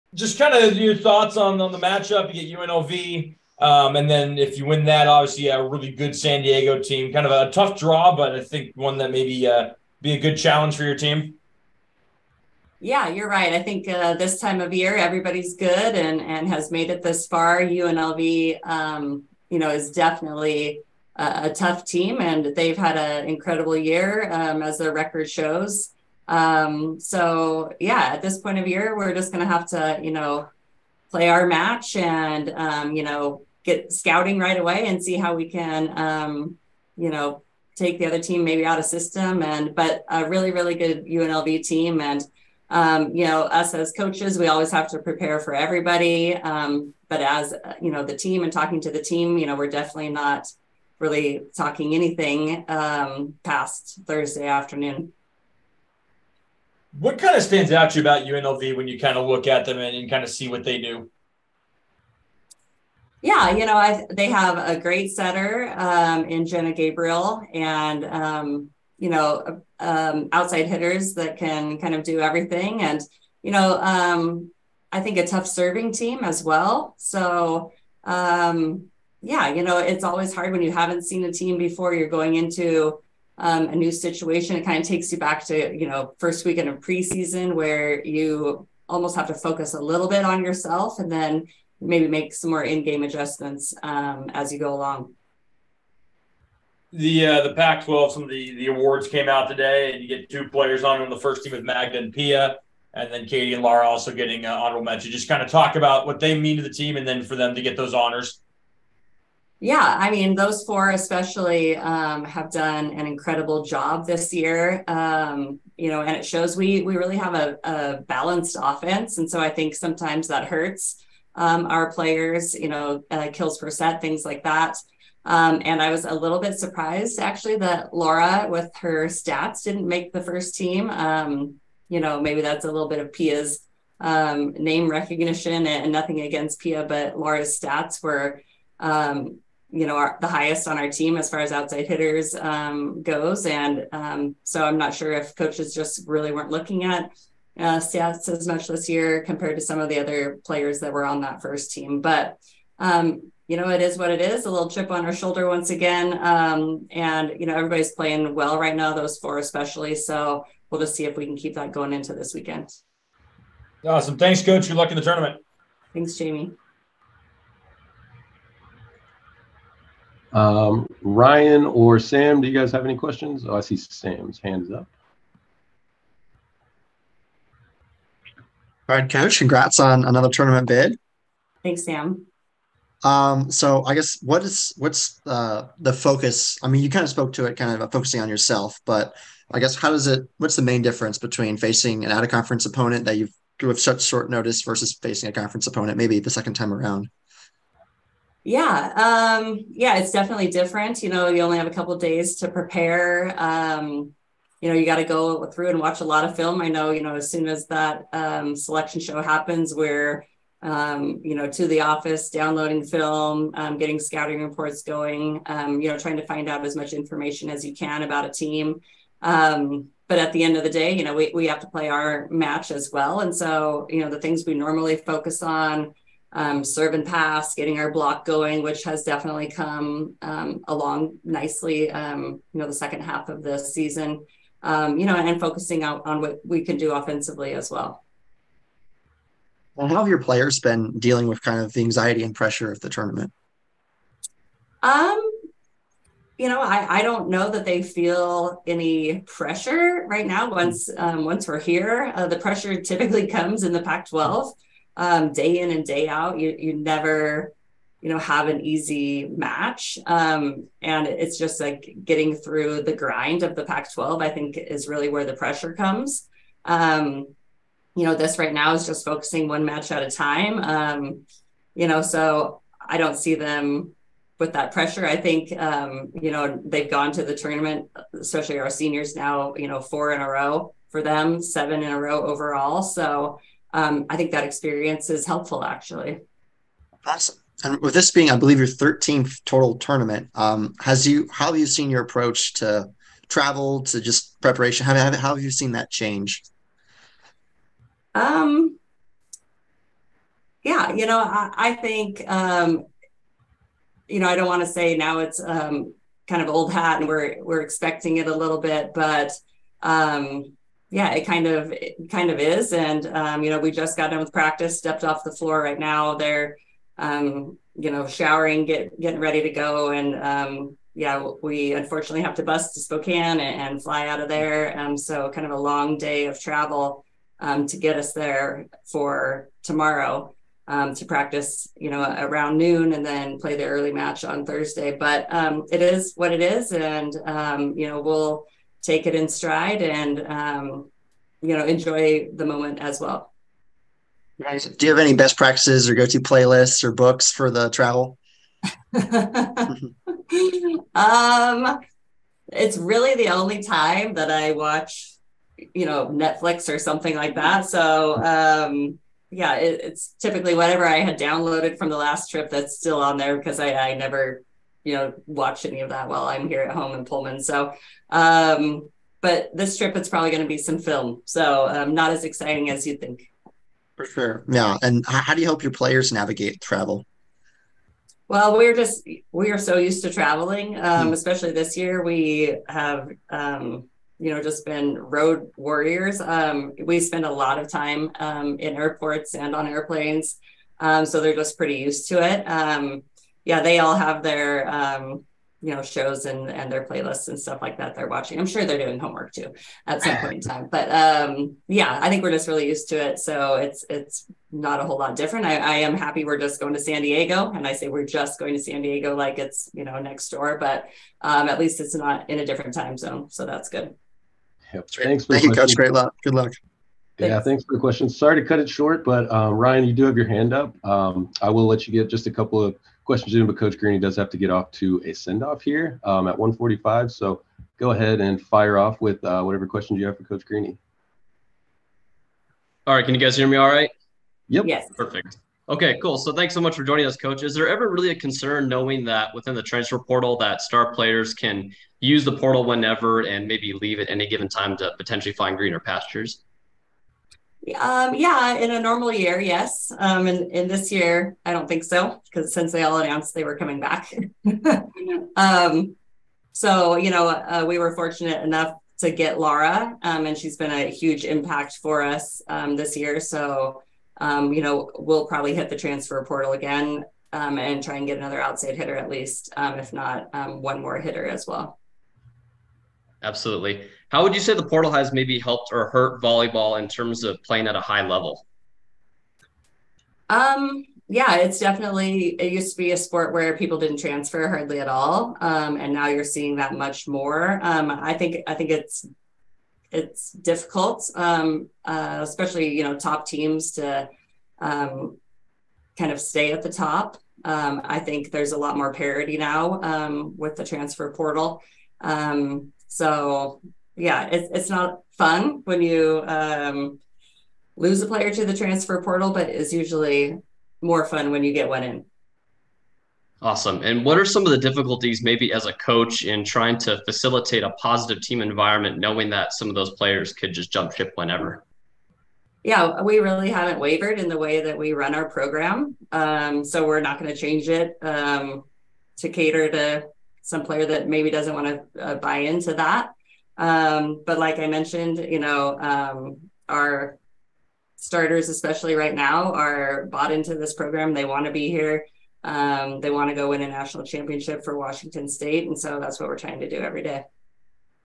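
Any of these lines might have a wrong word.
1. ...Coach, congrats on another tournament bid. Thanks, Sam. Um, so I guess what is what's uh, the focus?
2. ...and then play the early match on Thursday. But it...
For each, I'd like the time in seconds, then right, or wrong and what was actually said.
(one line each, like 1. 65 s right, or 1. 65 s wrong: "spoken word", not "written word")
1. 179 s right
2. 332 s right.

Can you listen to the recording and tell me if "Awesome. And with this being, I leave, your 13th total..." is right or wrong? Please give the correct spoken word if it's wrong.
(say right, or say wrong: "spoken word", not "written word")
wrong: "believe", not "leave".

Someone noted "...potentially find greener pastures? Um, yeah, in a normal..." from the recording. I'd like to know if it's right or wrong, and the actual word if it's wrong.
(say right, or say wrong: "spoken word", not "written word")
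right.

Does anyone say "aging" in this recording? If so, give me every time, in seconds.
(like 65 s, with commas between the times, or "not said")
not said.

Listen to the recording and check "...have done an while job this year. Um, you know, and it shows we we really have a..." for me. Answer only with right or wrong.
wrong.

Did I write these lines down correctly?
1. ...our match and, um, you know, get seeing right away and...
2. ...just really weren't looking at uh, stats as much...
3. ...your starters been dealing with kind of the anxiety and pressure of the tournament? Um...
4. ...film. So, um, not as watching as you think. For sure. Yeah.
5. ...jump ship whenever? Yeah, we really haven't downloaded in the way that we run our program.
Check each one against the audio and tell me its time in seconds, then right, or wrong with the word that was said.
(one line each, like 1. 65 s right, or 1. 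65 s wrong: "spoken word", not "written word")
1. 31 s wrong: "scouting", not "seeing"
2. 145 s right
3. 240 s wrong: "players", not "starters"
4. 370 s wrong: "exciting", not "watching"
5. 520 s wrong: "wavered", not "downloaded".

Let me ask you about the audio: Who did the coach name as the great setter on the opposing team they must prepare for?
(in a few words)
Jenna Gabriel.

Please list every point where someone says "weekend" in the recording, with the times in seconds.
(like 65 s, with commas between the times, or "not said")
86 s, 162 s.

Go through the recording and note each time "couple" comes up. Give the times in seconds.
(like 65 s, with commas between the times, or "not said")
201 s, 422 s.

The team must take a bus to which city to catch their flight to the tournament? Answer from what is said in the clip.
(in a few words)
Spokane.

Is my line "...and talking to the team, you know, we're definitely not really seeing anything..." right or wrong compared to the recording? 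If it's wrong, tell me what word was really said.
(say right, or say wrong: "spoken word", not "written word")
wrong: "talking", not "seeing".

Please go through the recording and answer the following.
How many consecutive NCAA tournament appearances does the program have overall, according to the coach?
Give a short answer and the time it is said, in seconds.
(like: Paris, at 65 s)
7, at 281 s.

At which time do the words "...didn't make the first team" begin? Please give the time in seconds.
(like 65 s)
129 s.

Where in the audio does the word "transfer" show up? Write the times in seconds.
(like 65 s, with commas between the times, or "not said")
439 s, 465 s, 483 s, 500 s, 508 s.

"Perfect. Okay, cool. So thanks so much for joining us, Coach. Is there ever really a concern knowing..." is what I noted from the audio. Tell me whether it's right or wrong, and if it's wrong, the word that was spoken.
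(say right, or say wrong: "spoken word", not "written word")
right.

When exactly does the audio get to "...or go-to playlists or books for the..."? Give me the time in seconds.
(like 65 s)
345 s.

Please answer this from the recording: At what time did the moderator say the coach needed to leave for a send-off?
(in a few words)
1:45.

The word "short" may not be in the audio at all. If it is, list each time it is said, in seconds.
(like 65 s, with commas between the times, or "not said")
194 s, 418 s.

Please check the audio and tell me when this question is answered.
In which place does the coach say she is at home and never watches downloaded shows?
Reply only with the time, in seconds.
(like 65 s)
367 s.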